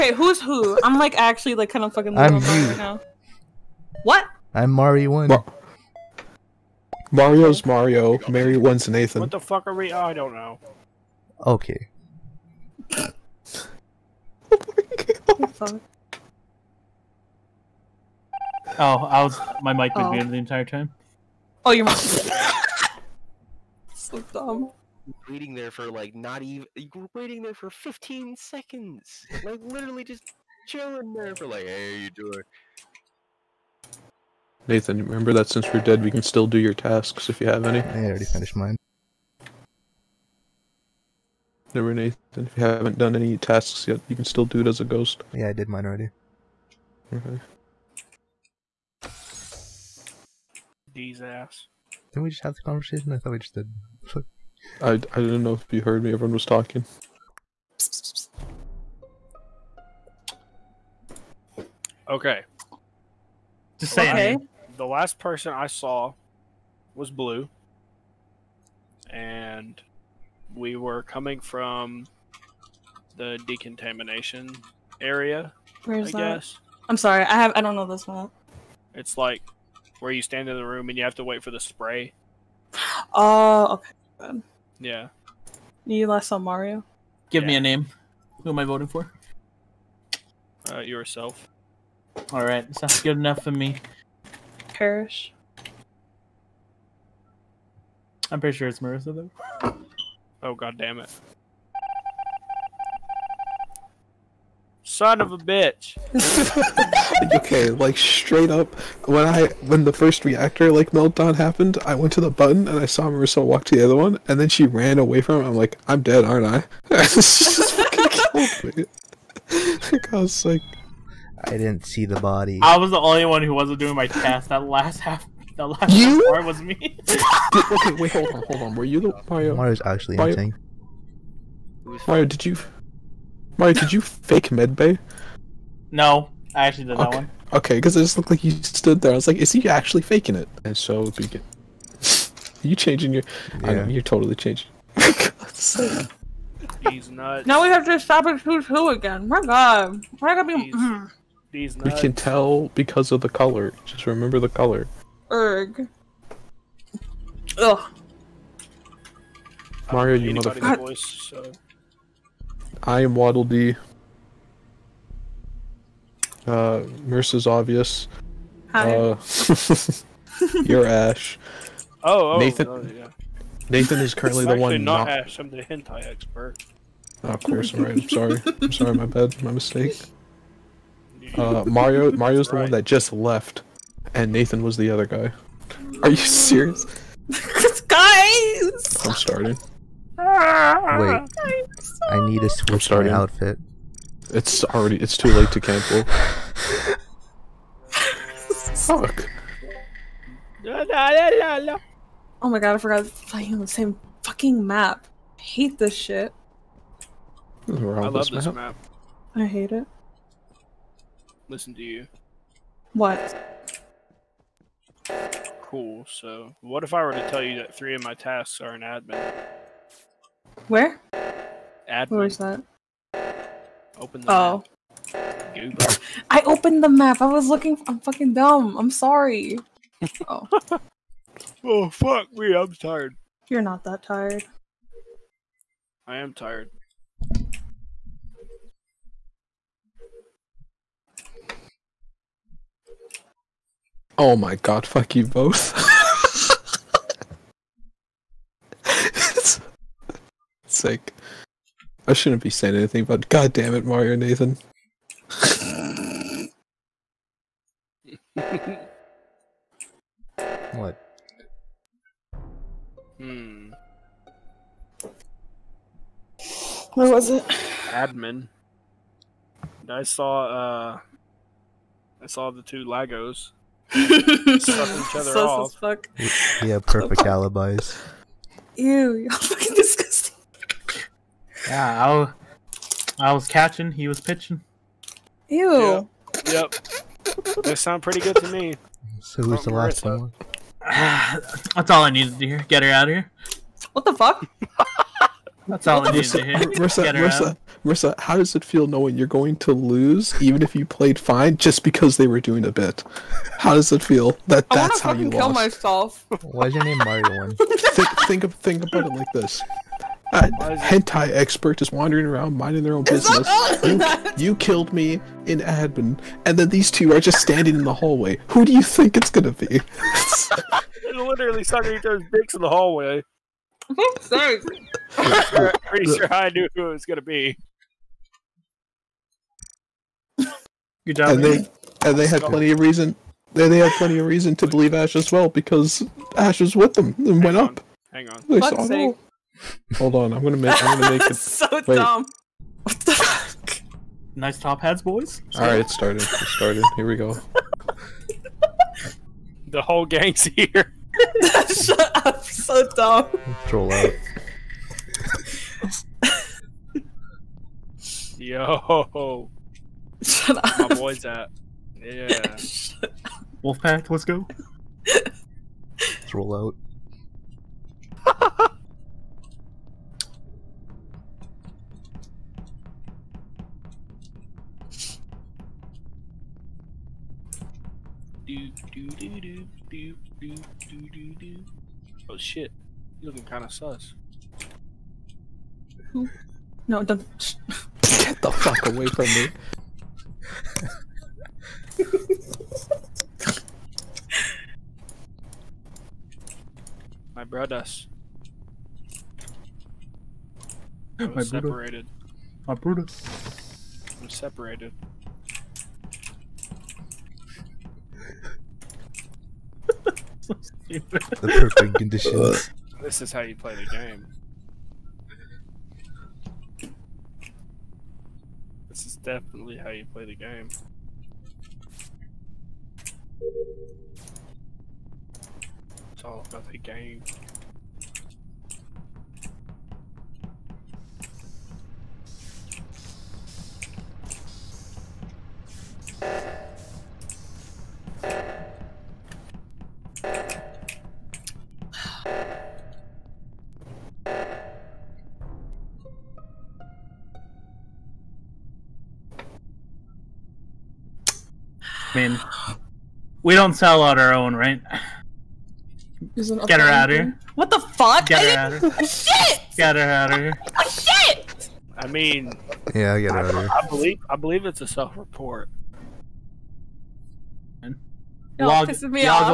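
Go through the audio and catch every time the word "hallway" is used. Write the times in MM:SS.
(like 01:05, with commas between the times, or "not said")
05:17, 05:22.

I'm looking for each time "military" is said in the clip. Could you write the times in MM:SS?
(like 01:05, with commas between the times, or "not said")
not said.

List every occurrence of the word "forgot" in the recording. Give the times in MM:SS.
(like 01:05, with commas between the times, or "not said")
03:22.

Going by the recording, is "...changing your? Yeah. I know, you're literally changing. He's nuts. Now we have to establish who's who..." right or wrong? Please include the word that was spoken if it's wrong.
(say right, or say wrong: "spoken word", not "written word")
wrong: "totally", not "literally".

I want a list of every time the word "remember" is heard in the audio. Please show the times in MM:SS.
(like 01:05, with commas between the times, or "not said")
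00:35, 02:34.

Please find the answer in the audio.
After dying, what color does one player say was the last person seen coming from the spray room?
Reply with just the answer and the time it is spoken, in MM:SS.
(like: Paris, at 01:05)
Blue, at 01:07.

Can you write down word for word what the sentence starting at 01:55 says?
I'm like, I'm dead, aren't I?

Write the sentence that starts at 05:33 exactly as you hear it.
They they had plenty of reason to believe Ash as well because Ash was with them and Hang went on.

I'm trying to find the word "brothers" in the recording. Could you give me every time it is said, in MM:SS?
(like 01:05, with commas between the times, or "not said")
06:37, 06:42.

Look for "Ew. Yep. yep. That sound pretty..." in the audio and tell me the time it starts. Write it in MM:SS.
04:45.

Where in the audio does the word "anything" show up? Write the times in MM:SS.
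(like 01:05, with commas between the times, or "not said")
04:12.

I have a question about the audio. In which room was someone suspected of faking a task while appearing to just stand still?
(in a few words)
Medbay.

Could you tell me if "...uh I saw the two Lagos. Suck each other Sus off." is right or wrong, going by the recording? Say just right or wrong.
right.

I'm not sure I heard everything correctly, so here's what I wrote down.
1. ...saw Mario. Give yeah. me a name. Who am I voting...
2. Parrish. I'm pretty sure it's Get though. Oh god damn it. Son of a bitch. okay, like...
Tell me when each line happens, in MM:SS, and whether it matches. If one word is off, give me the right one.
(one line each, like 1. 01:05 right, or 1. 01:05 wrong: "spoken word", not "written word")
1. 01:26 right
2. 01:34 wrong: "Marissa", not "Get".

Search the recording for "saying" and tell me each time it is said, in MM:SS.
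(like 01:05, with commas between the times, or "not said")
01:03, 04:12.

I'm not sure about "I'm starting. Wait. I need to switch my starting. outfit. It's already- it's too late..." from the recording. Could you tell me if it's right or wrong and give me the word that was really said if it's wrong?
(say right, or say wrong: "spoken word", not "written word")
right.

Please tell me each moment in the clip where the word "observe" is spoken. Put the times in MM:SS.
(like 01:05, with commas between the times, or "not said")
not said.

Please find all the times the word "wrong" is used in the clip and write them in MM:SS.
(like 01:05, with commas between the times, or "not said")
not said.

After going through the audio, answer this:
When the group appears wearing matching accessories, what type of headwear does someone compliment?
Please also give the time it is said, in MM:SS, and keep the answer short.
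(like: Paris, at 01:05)
Top hats, at 05:44.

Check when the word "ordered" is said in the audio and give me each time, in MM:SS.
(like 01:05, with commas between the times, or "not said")
not said.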